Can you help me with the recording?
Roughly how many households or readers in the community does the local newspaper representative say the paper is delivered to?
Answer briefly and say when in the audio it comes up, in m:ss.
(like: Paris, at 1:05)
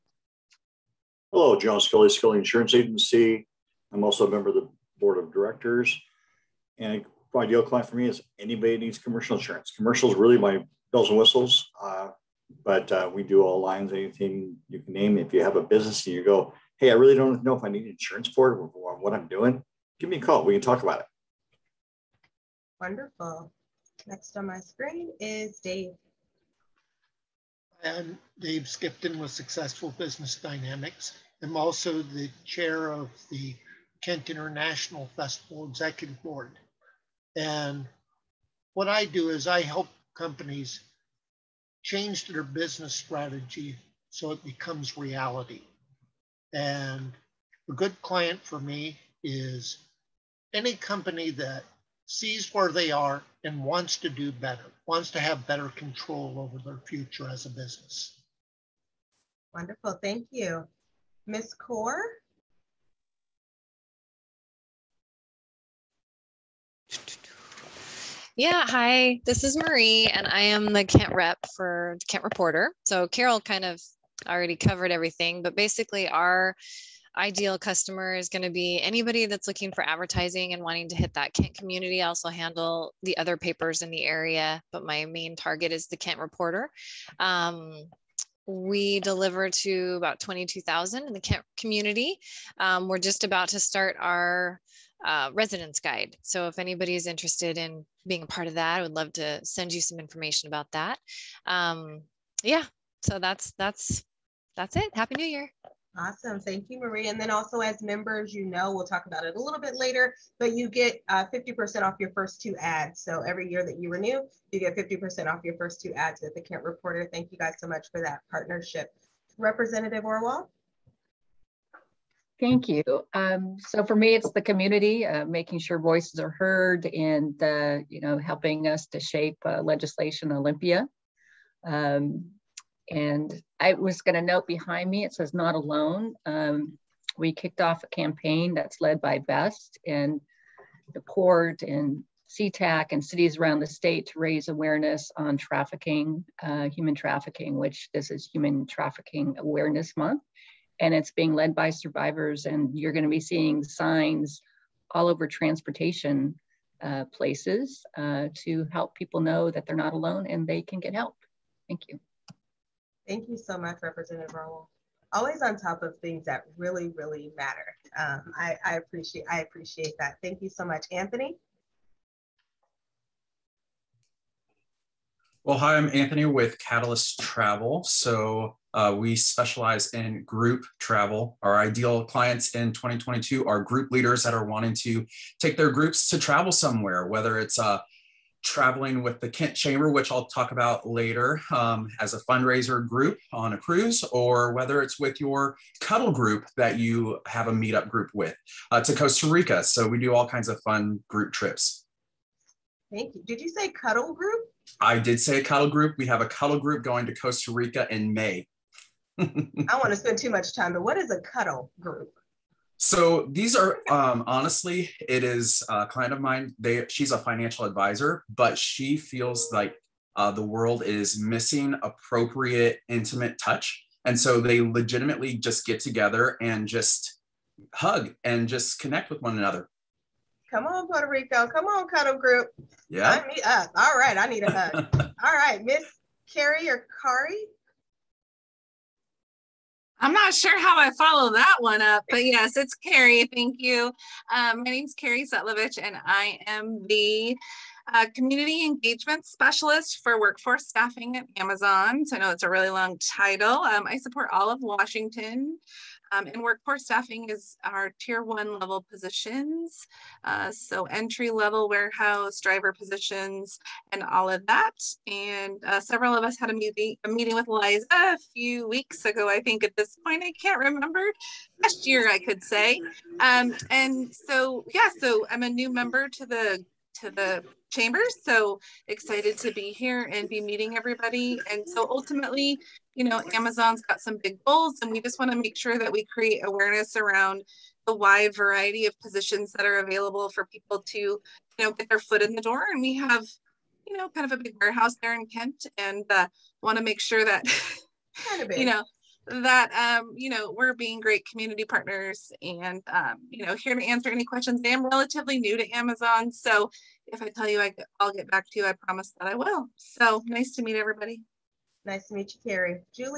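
22,000, at 1:30.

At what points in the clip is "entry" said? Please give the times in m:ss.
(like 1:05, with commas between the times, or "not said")
4:20.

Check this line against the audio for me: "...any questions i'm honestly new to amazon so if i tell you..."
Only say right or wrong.
wrong.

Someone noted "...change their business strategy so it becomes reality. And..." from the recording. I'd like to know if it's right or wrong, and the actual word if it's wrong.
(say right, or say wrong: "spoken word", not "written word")
right.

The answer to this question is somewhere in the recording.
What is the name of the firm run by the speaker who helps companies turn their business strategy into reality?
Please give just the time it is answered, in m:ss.
0:29.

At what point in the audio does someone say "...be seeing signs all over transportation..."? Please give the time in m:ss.
2:33.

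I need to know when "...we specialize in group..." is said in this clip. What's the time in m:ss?
2:58.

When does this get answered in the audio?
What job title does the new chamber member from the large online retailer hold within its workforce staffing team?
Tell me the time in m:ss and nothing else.
4:08.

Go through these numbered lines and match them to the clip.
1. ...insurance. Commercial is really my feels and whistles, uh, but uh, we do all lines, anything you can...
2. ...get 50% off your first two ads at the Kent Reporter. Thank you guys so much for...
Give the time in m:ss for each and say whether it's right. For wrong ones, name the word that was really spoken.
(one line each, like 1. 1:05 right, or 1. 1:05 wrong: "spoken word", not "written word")
1. 0:09 wrong: "bells", not "feels"
2. 1:54 right.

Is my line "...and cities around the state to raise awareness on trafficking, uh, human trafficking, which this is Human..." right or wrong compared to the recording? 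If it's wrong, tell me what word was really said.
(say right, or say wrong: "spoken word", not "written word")
right.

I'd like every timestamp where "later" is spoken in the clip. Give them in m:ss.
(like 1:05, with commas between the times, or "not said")
1:49, 3:10.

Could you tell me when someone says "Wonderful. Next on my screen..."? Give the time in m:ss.
0:22.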